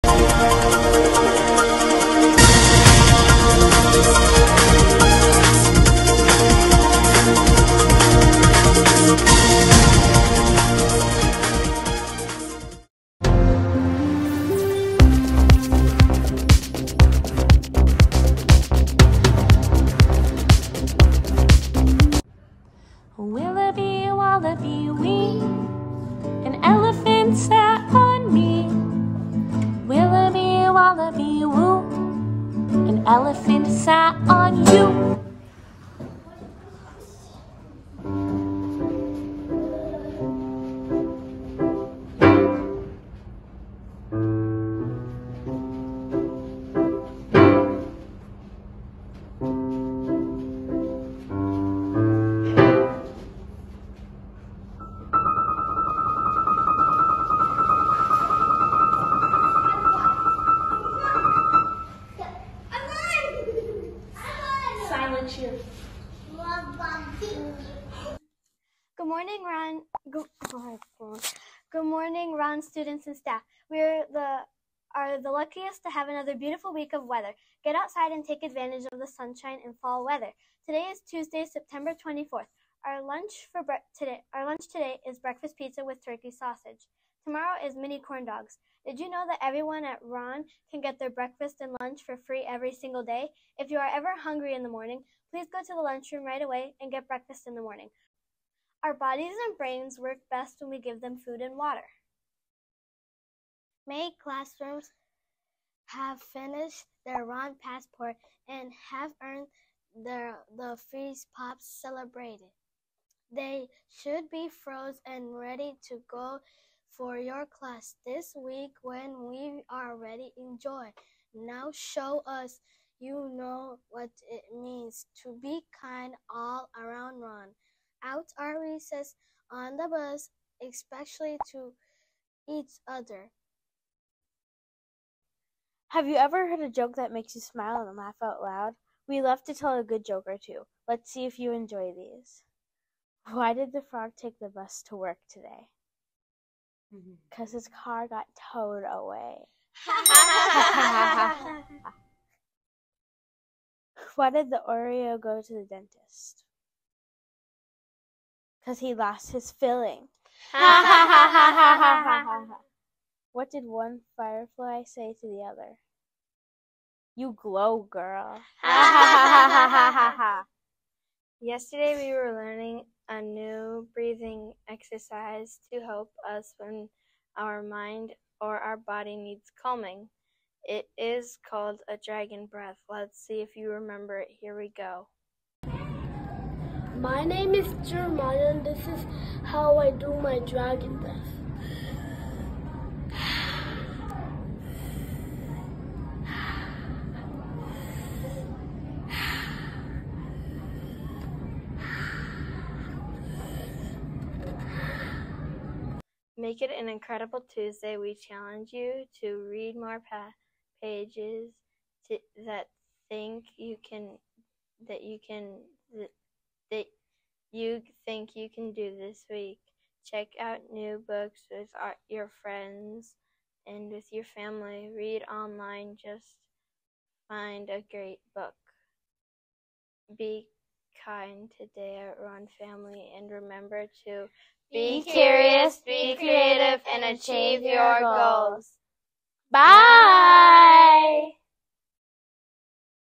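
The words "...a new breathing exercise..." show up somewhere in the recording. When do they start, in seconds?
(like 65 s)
173 s.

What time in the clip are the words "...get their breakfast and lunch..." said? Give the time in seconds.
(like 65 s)
90 s.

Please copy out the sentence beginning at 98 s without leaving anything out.
Our bodies and brains work best when we give them food and water.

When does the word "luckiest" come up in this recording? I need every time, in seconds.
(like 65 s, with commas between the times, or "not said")
75 s.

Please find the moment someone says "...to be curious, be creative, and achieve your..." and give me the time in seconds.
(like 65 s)
234 s.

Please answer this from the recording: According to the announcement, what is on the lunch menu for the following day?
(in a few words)
Mini corn dogs.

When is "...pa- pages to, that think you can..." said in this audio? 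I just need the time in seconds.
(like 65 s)
210 s.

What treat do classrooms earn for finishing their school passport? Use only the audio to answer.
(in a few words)
Freeze pops.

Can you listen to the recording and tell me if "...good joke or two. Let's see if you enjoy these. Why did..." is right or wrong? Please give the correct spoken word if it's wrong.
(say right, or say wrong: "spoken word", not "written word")
right.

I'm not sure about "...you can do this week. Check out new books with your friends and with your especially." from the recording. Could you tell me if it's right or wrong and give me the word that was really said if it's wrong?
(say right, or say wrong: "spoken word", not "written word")
wrong: "family", not "especially".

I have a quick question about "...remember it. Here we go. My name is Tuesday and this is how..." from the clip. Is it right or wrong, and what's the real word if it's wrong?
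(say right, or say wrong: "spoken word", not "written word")
wrong: "Jeremiah", not "Tuesday".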